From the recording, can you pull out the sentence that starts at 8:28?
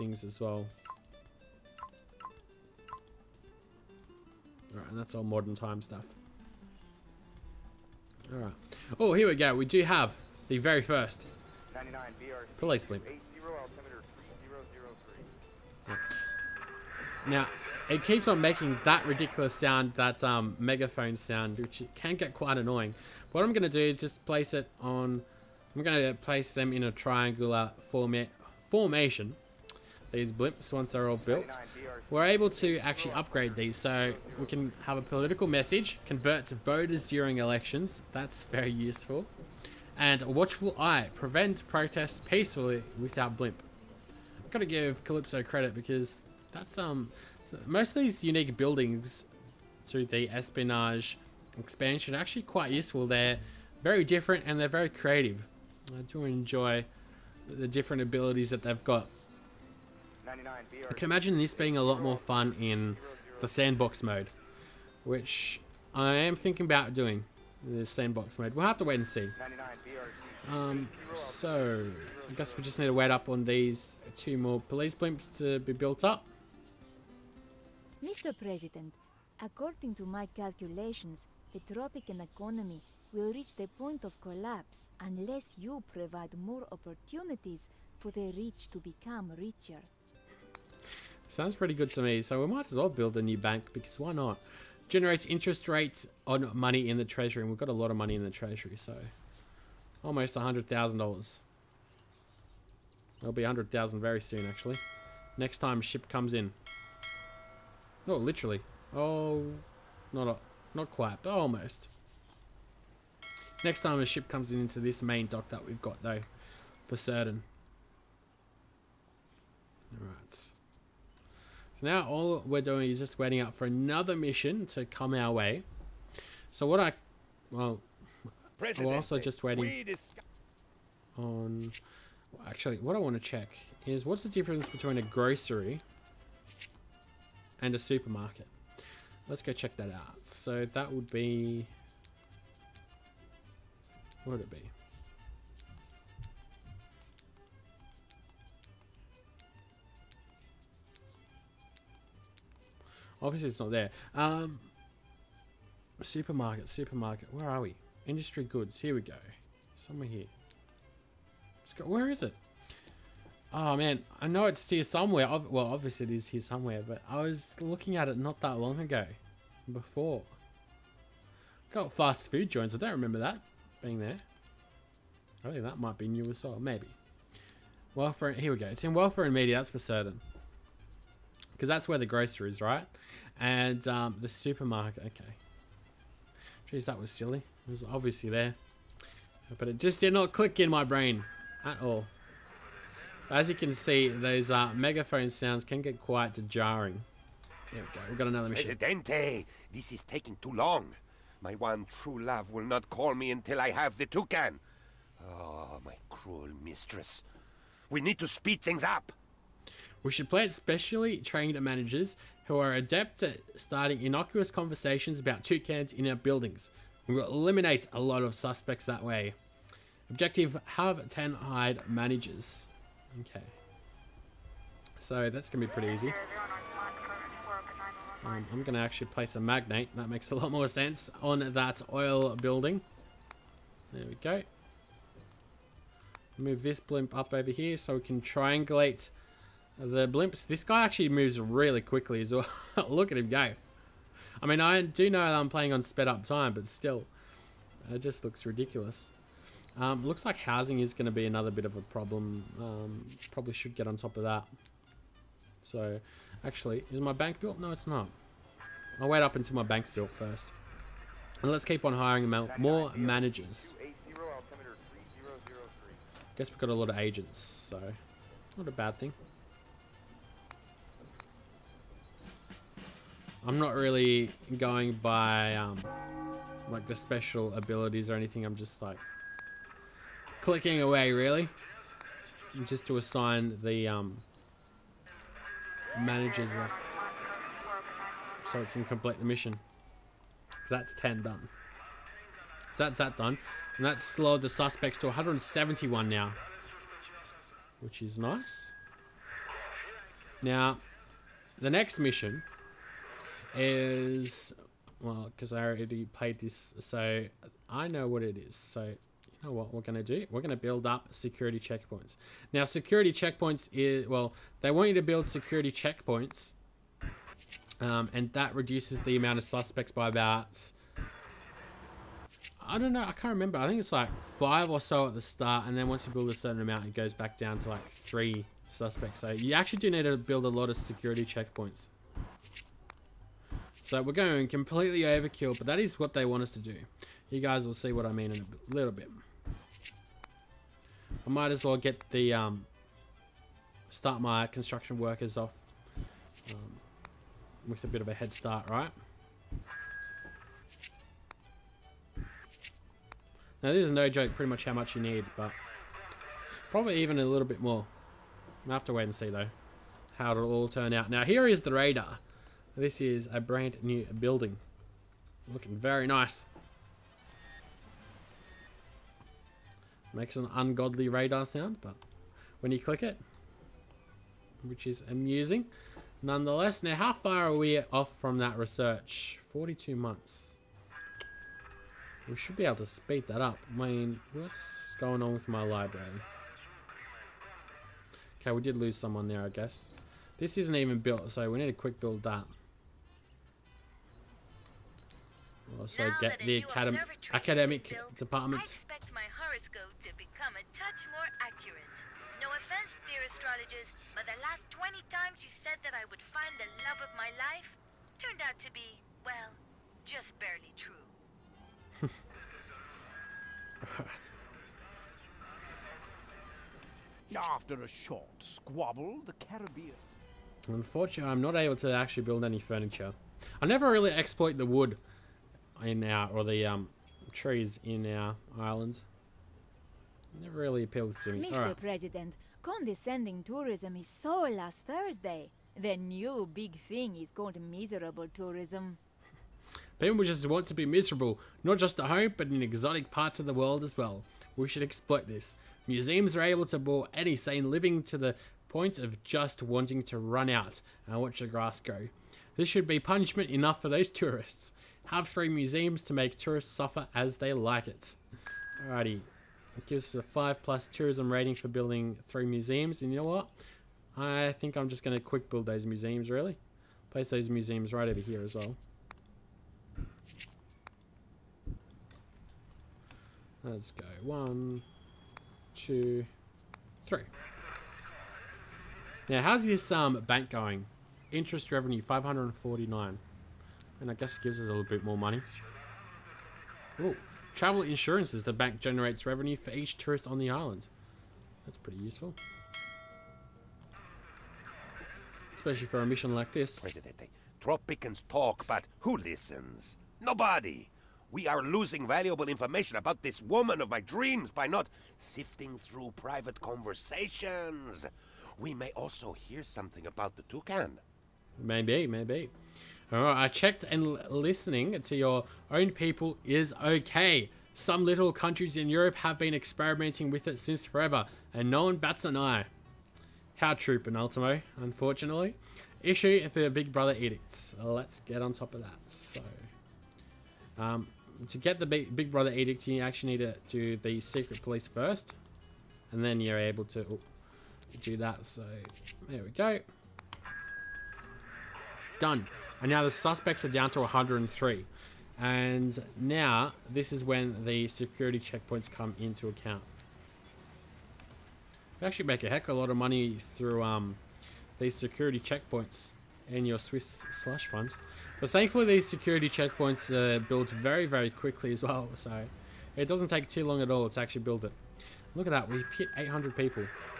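We may also hear something about the toucan.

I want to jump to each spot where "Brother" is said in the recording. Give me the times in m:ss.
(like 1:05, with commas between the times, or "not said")
8:46, 8:52.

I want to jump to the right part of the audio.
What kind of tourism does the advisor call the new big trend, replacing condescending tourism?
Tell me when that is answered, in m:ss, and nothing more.
7:17.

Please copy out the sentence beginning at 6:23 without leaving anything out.
I mean, what's going on with my library?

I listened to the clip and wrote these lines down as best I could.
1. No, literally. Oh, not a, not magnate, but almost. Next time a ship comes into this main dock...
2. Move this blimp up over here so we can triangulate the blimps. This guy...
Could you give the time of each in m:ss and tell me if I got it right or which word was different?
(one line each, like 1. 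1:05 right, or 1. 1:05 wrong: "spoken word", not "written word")
1. 1:48 wrong: "quite", not "magnate"
2. 3:56 right.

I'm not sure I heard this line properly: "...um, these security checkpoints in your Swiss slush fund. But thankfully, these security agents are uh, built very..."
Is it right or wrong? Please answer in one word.
wrong.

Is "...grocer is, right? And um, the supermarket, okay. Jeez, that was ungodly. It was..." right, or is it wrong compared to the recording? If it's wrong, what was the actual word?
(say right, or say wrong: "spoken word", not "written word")
wrong: "silly", not "ungodly".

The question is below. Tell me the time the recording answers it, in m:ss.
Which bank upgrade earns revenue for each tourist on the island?
8:07.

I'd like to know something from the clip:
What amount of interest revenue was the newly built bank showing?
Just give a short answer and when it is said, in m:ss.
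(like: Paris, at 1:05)
549, at 8:02.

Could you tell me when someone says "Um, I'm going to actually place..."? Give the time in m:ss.
3:48.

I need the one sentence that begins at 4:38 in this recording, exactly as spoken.
I'm just like clicking away, really.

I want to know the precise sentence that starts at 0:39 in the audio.
And a watchful eye prevents protests peacefully without blimp.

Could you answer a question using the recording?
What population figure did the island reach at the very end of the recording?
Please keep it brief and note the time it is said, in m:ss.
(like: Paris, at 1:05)
800, at 9:26.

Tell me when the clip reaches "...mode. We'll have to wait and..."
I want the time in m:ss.
1:08.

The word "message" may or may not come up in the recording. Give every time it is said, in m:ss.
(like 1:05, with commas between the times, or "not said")
0:35.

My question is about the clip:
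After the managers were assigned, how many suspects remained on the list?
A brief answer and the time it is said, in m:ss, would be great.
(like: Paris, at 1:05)
171, at 4:55.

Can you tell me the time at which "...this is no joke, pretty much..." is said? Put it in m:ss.
5:53.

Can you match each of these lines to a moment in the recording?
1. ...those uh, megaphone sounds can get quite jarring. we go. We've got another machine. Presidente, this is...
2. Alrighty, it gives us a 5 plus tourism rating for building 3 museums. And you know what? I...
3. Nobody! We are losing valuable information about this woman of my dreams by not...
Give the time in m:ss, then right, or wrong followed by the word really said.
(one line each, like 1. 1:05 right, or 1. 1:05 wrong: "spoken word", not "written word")
1. 3:14 right
2. 7:38 right
3. 8:20 right.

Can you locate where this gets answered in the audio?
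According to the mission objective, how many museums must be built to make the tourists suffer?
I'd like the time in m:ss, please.
7:35.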